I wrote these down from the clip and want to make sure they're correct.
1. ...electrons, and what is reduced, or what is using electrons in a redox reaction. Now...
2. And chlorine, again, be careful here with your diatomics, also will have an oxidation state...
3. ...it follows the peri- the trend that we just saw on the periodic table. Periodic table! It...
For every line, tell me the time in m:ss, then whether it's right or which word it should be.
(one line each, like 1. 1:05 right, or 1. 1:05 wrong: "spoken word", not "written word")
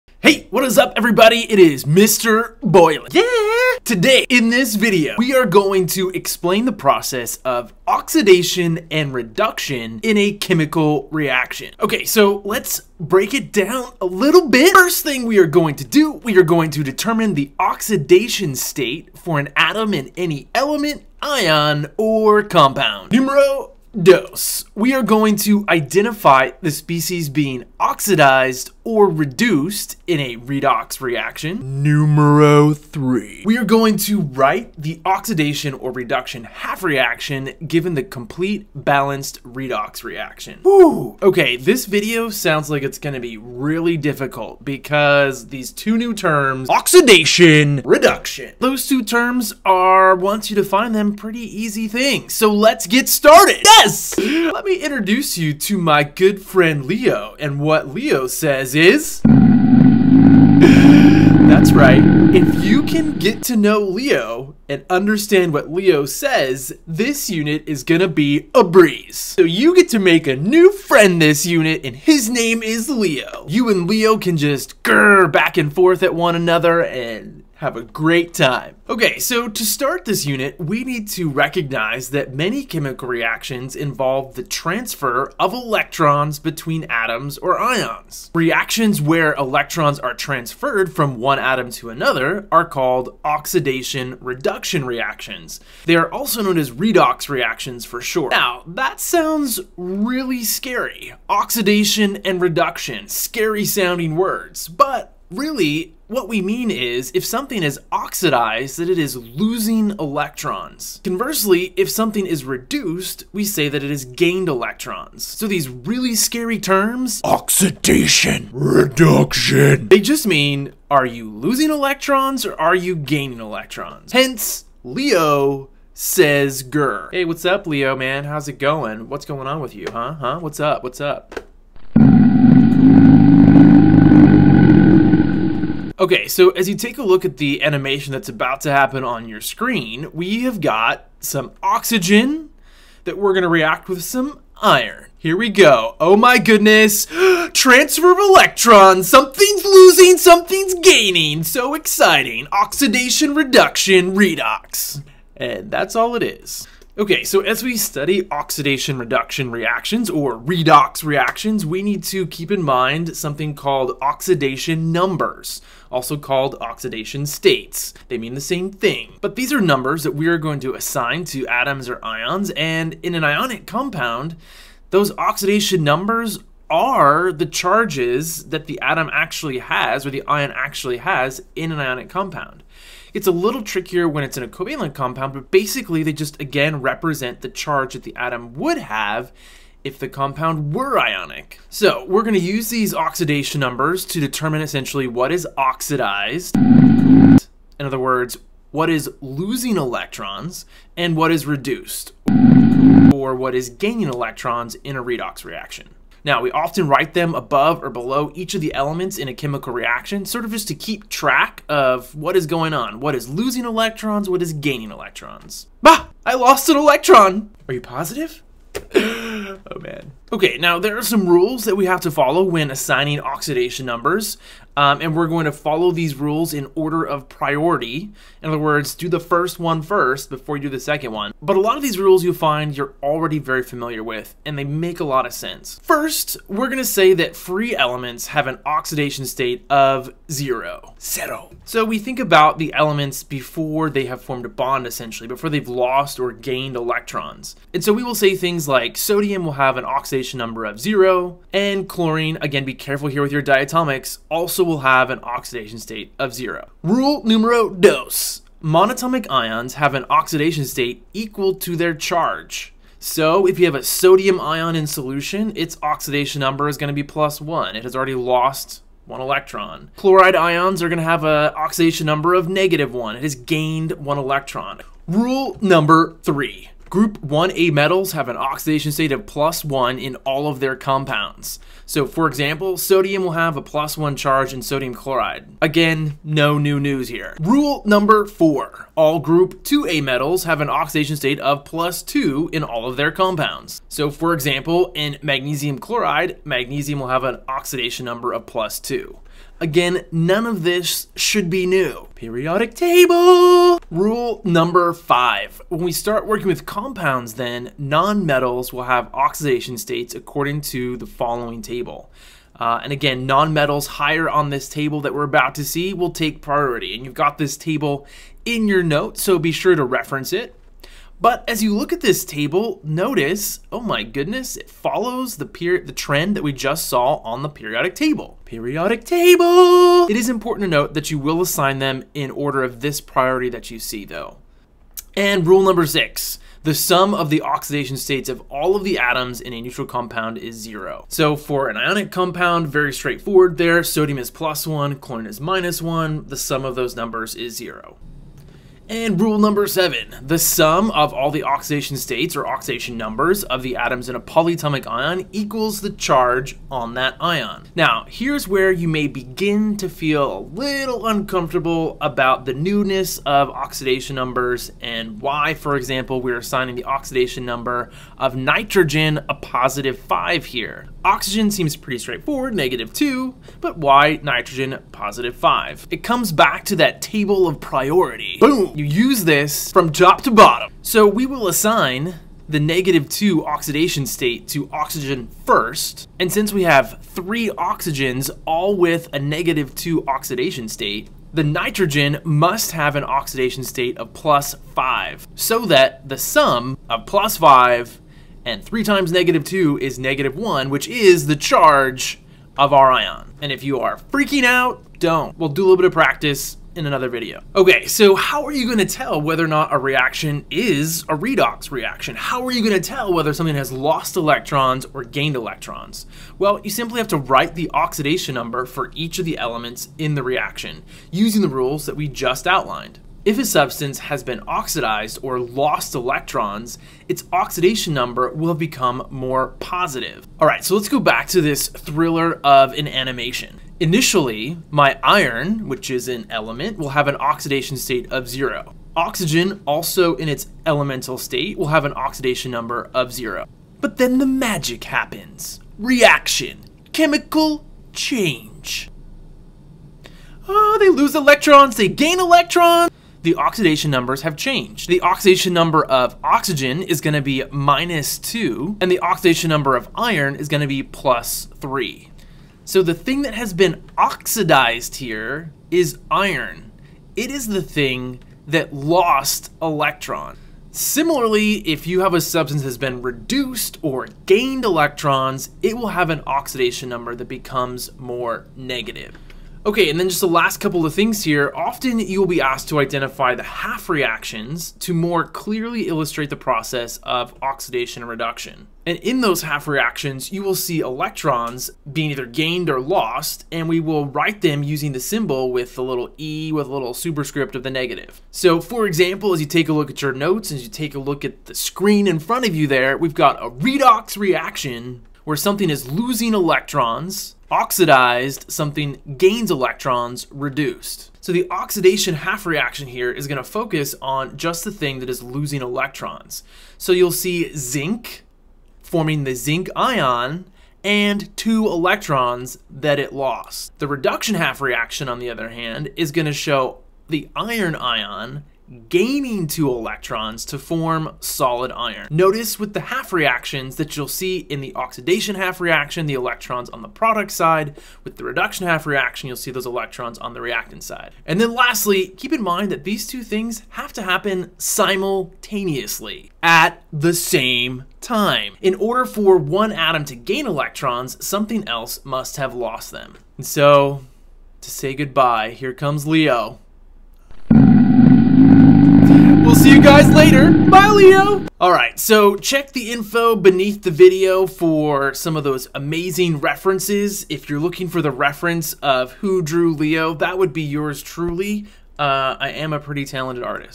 1. 3:19 wrong: "gaining", not "using"
2. 4:11 right
3. 5:24 right.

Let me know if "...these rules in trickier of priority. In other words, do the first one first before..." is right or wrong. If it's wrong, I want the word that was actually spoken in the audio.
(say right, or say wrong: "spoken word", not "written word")
wrong: "order", not "trickier".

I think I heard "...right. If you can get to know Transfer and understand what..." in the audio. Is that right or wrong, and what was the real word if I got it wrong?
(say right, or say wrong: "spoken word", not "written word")
wrong: "Leo", not "Transfer".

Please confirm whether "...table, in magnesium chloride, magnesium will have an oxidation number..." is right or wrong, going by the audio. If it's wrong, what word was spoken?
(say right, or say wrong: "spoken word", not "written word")
wrong: "example", not "table".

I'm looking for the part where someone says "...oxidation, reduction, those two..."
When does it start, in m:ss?
0:46.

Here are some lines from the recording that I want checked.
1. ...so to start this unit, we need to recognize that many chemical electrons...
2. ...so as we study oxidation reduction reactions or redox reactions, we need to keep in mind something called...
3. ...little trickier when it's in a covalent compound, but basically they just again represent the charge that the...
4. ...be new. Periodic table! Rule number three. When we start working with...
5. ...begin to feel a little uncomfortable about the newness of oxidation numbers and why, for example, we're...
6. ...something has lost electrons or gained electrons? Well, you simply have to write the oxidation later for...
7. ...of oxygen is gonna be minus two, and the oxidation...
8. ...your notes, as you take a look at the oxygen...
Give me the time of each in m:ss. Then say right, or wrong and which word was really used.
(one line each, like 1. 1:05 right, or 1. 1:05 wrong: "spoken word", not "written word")
1. 1:19 wrong: "reactions", not "electrons"
2. 2:37 right
3. 3:03 right
4. 5:01 wrong: "five", not "three"
5. 5:59 right
6. 6:53 wrong: "number", not "later"
7. 7:35 right
8. 8:20 wrong: "screen", not "oxygen".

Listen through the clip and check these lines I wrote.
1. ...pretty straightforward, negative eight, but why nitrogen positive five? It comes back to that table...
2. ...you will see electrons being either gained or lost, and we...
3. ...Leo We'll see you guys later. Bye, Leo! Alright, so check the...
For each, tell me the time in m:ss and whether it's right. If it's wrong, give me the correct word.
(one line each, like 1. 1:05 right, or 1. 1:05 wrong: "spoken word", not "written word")
1. 6:11 wrong: "two", not "eight"
2. 8:10 right
3. 9:16 right.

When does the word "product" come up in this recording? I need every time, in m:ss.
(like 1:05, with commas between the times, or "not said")
8:56.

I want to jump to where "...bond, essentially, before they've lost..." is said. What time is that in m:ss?
4:04.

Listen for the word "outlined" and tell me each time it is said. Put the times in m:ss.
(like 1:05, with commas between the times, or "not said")
7:02.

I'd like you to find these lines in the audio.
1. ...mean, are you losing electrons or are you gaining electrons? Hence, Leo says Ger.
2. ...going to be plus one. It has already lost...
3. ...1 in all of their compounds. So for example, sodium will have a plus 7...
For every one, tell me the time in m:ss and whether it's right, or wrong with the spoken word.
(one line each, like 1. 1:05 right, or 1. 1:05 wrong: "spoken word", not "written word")
1. 2:00 right
2. 4:26 right
3. 4:39 wrong: "1", not "7".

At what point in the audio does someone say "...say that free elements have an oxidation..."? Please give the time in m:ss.
3:56.